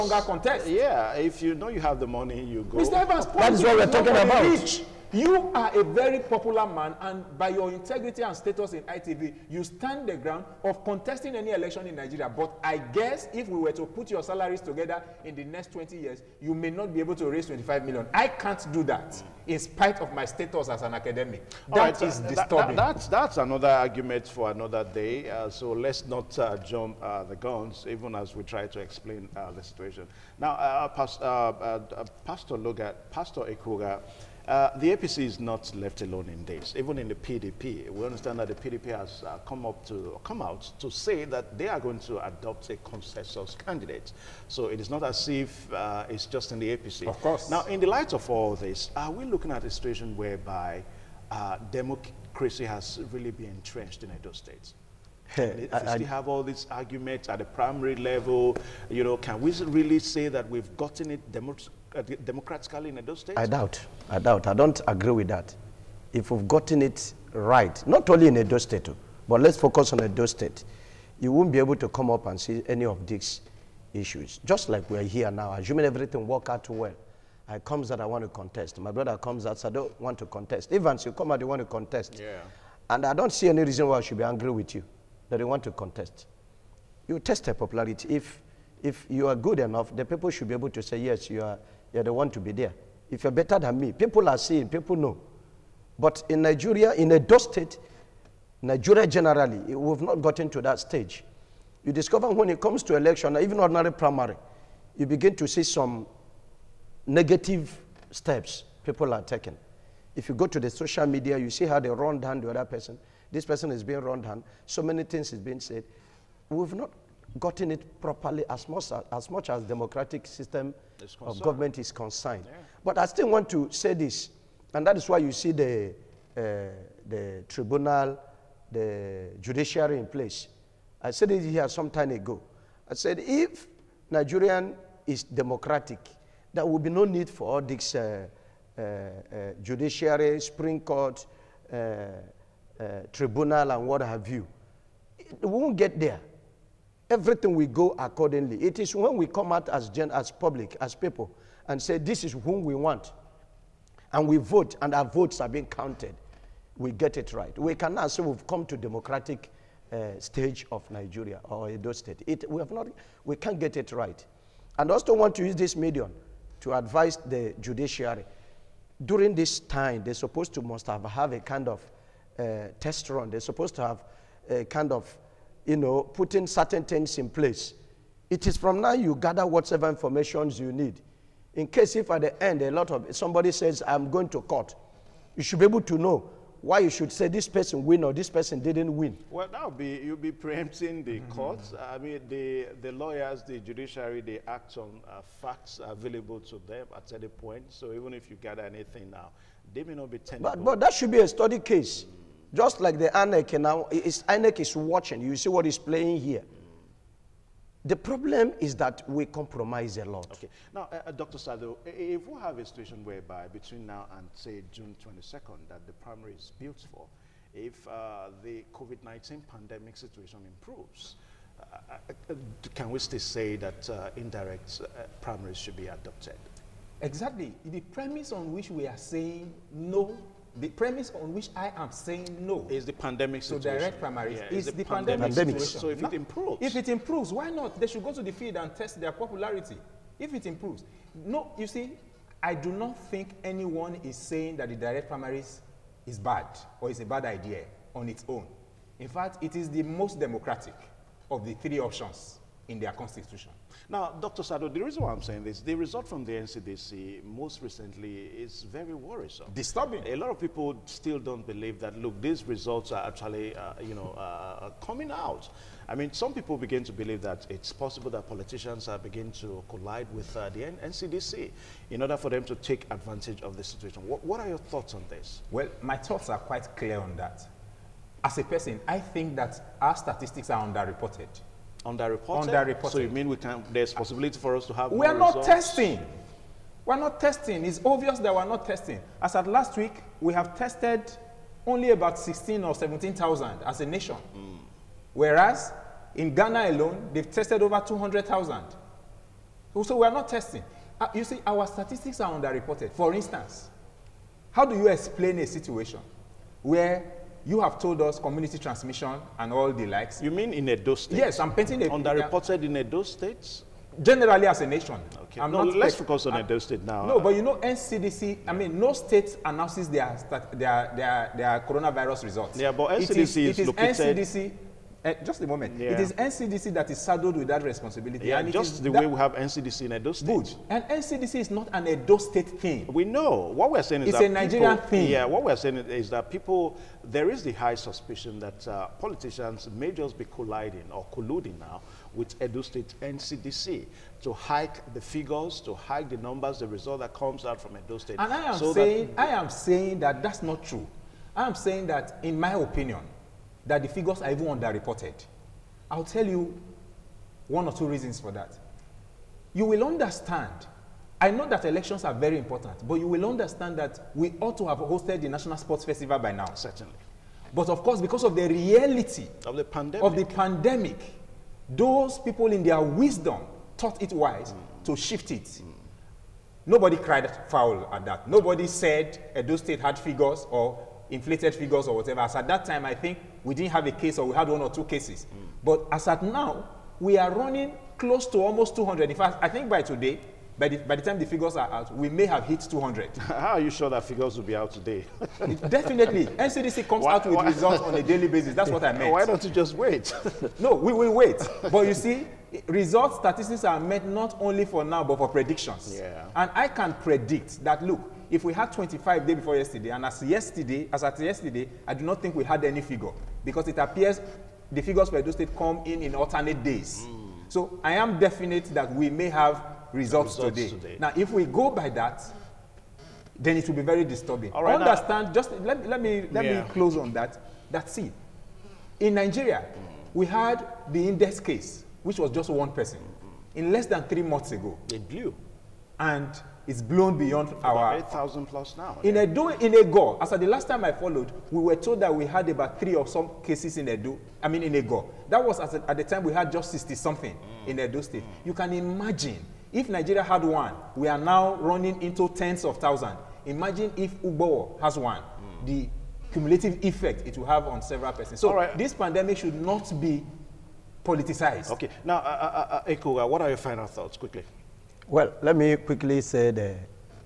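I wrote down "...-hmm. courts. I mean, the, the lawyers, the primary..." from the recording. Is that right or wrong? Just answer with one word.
wrong.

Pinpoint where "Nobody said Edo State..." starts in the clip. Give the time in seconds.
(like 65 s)
378 s.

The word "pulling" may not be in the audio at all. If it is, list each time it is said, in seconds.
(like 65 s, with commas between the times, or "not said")
not said.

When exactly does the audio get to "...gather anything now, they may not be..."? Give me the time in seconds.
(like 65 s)
198 s.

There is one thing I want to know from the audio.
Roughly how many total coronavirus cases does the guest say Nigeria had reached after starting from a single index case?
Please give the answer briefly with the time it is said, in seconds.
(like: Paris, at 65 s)
8,000 plus, at 437 s.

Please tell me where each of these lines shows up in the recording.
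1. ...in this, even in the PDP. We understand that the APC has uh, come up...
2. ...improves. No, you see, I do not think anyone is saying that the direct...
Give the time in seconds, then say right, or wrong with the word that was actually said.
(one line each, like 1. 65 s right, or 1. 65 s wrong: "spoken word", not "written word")
1. 36 s wrong: "PDP", not "APC"
2. 240 s right.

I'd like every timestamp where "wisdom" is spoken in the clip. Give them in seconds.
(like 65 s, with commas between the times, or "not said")
372 s.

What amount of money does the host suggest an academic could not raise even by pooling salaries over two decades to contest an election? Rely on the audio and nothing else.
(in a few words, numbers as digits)
25 million.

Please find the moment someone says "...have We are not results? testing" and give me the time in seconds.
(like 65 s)
284 s.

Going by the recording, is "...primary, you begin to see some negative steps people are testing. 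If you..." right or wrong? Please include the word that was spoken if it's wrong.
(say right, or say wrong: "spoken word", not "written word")
wrong: "taking", not "testing".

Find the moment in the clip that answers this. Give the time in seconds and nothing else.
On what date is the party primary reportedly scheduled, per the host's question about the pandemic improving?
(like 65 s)
214 s.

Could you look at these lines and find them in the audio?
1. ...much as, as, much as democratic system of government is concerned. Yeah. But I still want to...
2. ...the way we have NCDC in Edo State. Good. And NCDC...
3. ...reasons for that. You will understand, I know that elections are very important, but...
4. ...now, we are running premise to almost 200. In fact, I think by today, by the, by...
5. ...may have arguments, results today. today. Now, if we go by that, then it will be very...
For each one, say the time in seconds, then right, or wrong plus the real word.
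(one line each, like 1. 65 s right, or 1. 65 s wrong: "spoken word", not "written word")
1. 118 s right
2. 328 s right
3. 357 s right
4. 386 s wrong: "close", not "premise"
5. 419 s wrong: "results", not "arguments".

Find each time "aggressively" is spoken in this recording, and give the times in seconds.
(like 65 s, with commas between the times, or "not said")
not said.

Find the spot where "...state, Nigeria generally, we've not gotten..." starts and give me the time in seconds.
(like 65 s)
97 s.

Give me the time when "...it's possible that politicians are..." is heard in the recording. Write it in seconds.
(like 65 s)
267 s.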